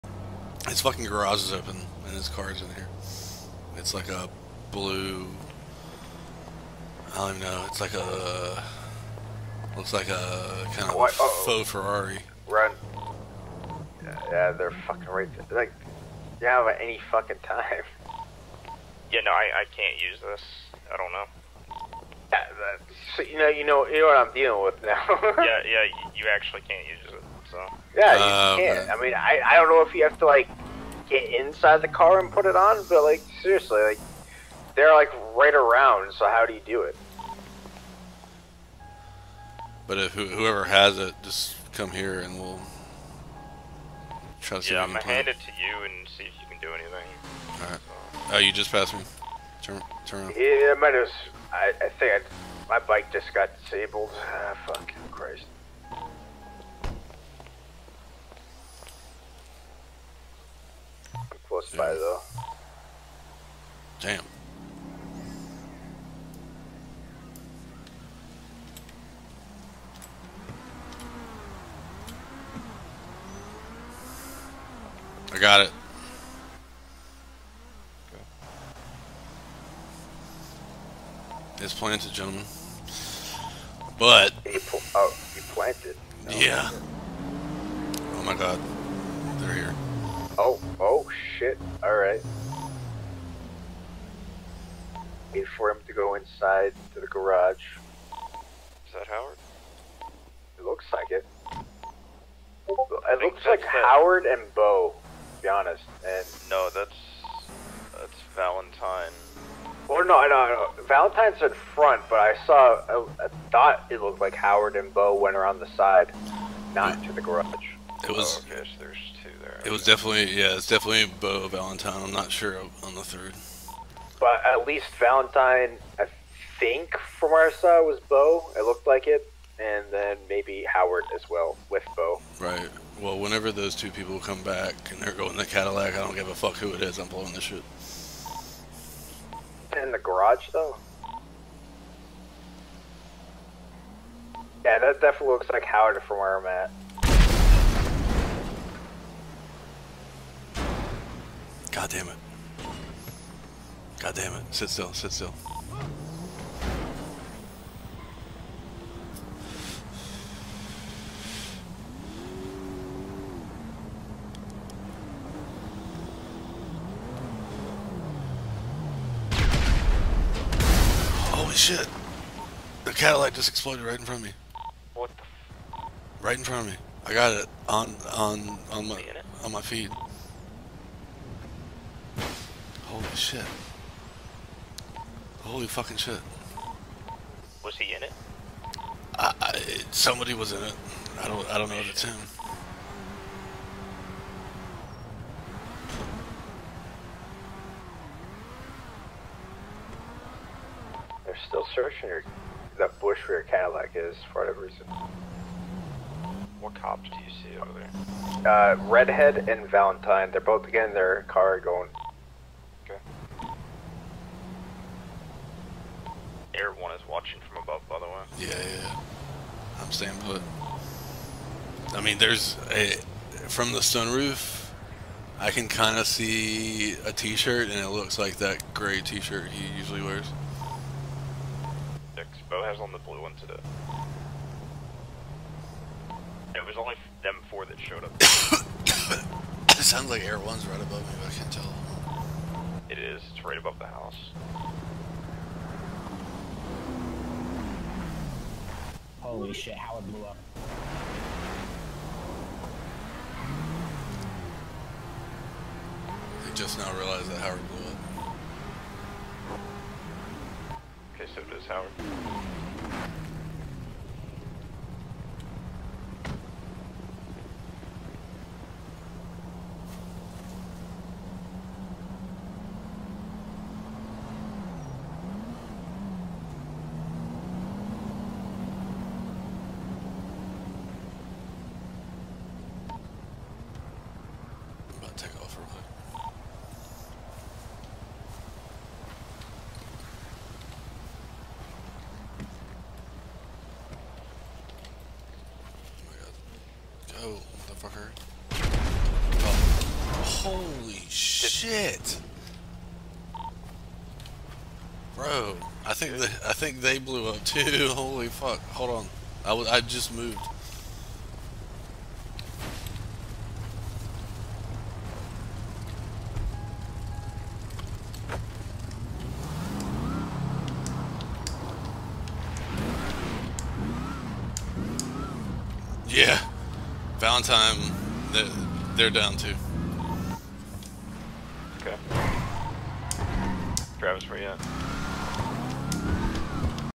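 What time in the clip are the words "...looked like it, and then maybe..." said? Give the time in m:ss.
2:08.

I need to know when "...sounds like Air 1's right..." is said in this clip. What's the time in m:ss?
3:59.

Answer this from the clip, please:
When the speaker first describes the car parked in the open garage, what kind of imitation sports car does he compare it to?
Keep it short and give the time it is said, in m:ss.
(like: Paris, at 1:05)
faux Ferrari, at 0:11.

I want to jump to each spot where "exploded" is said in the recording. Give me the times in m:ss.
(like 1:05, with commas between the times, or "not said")
2:53.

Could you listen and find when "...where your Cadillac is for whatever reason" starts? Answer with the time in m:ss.
3:23.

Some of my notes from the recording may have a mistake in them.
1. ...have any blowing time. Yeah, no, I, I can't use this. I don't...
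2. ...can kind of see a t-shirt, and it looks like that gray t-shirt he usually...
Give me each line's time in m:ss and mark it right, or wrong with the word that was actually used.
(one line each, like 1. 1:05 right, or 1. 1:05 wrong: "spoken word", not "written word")
1. 0:16 wrong: "fucking", not "blowing"
2. 3:45 right.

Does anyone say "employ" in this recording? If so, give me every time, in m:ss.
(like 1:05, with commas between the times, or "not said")
not said.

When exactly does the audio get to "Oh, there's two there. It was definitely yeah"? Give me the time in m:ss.
1:58.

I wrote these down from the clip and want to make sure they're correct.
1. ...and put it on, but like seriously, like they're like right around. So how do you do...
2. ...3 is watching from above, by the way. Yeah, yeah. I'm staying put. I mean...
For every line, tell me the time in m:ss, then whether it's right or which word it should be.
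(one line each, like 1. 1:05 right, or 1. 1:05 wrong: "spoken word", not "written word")
1. 0:32 right
2. 3:36 wrong: "1", not "3".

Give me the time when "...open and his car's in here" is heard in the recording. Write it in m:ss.
0:01.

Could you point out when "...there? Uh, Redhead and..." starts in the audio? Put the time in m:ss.
3:27.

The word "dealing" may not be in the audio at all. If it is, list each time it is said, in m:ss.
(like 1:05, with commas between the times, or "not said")
0:24.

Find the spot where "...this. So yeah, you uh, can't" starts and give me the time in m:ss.
0:27.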